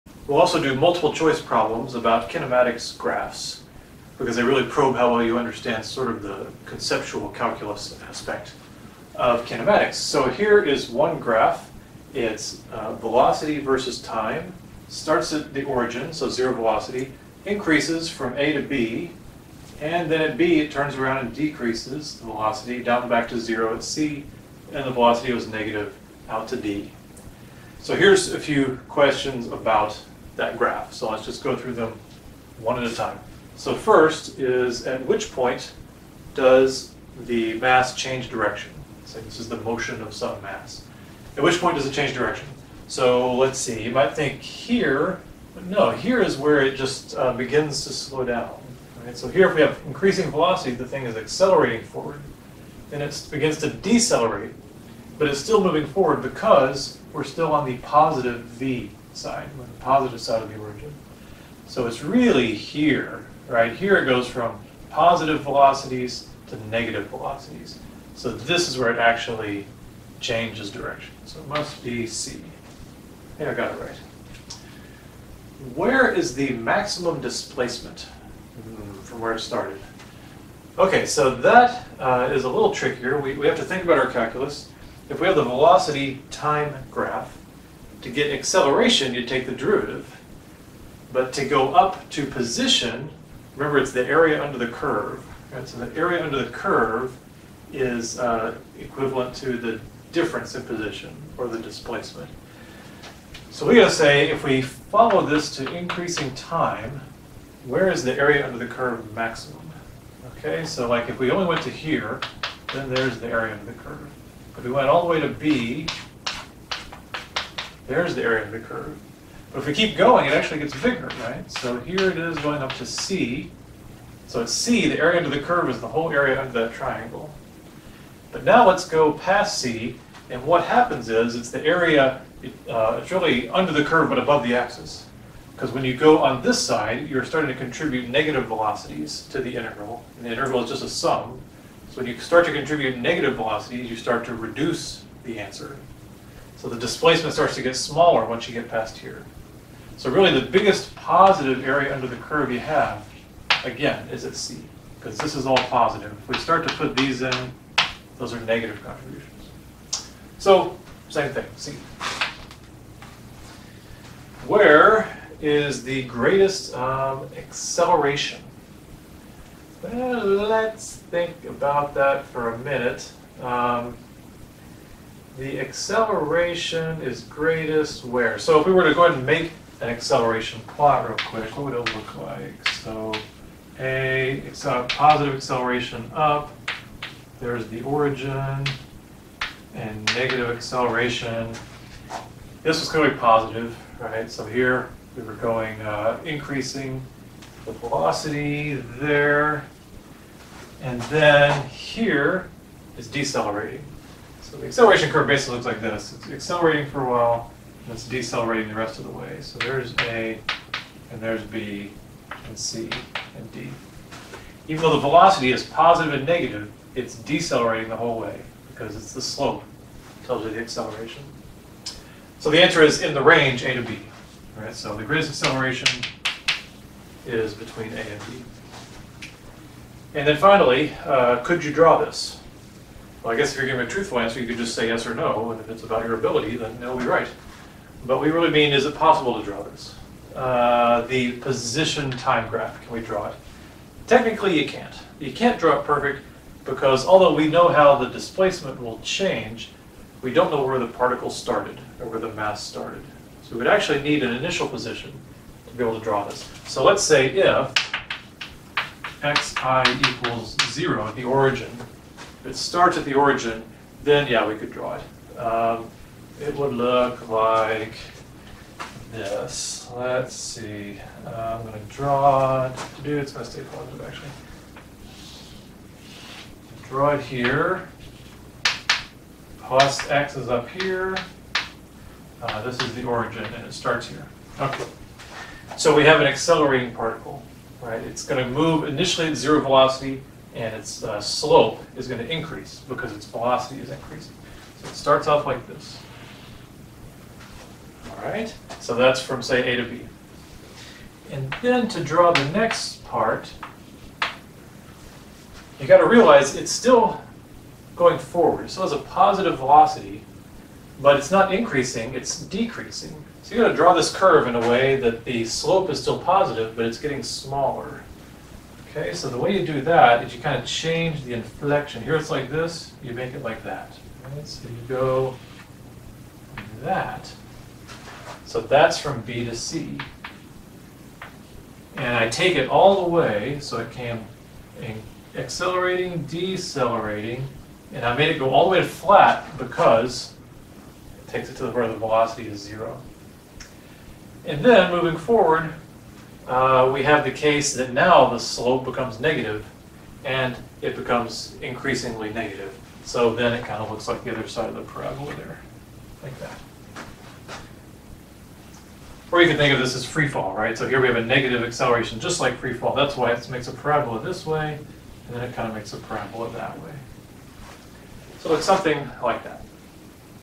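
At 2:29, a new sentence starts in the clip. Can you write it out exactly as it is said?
So really the biggest positive area under the curve you have, again, is at C, because this is all positive.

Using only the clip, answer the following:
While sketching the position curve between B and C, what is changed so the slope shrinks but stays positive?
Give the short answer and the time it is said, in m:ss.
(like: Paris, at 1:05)
the inflection, at 5:21.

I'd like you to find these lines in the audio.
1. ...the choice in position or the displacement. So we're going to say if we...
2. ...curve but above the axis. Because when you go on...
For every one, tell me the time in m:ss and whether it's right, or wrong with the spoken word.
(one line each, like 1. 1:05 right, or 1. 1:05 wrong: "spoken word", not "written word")
1. 1:39 wrong: "difference", not "choice"
2. 2:13 right.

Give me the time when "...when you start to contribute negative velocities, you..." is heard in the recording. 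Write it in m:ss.
2:22.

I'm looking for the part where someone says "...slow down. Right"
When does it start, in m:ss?
0:47.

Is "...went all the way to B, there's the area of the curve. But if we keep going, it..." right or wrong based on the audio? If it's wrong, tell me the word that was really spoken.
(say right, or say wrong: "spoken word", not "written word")
right.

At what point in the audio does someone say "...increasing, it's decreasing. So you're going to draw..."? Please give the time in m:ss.
5:11.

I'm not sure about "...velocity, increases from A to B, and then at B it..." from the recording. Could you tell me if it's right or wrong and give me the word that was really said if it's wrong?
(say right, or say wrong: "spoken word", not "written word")
right.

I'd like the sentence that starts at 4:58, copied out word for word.
All right, so that's from, say, A to B.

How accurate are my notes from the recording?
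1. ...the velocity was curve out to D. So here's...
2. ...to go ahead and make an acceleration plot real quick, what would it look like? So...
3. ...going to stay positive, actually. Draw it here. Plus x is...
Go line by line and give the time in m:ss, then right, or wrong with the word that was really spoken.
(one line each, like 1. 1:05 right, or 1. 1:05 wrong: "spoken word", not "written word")
1. 0:24 wrong: "negative", not "curve"
2. 2:58 right
3. 4:33 right.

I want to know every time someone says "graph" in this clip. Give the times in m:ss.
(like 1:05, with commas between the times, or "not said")
0:02, 0:11, 0:30, 1:26, 4:02.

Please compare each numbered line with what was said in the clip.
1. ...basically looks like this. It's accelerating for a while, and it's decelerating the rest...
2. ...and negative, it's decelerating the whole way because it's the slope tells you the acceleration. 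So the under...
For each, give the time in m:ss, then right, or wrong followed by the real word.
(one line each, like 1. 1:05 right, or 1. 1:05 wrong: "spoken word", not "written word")
1. 3:25 right
2. 3:36 wrong: "answer", not "under".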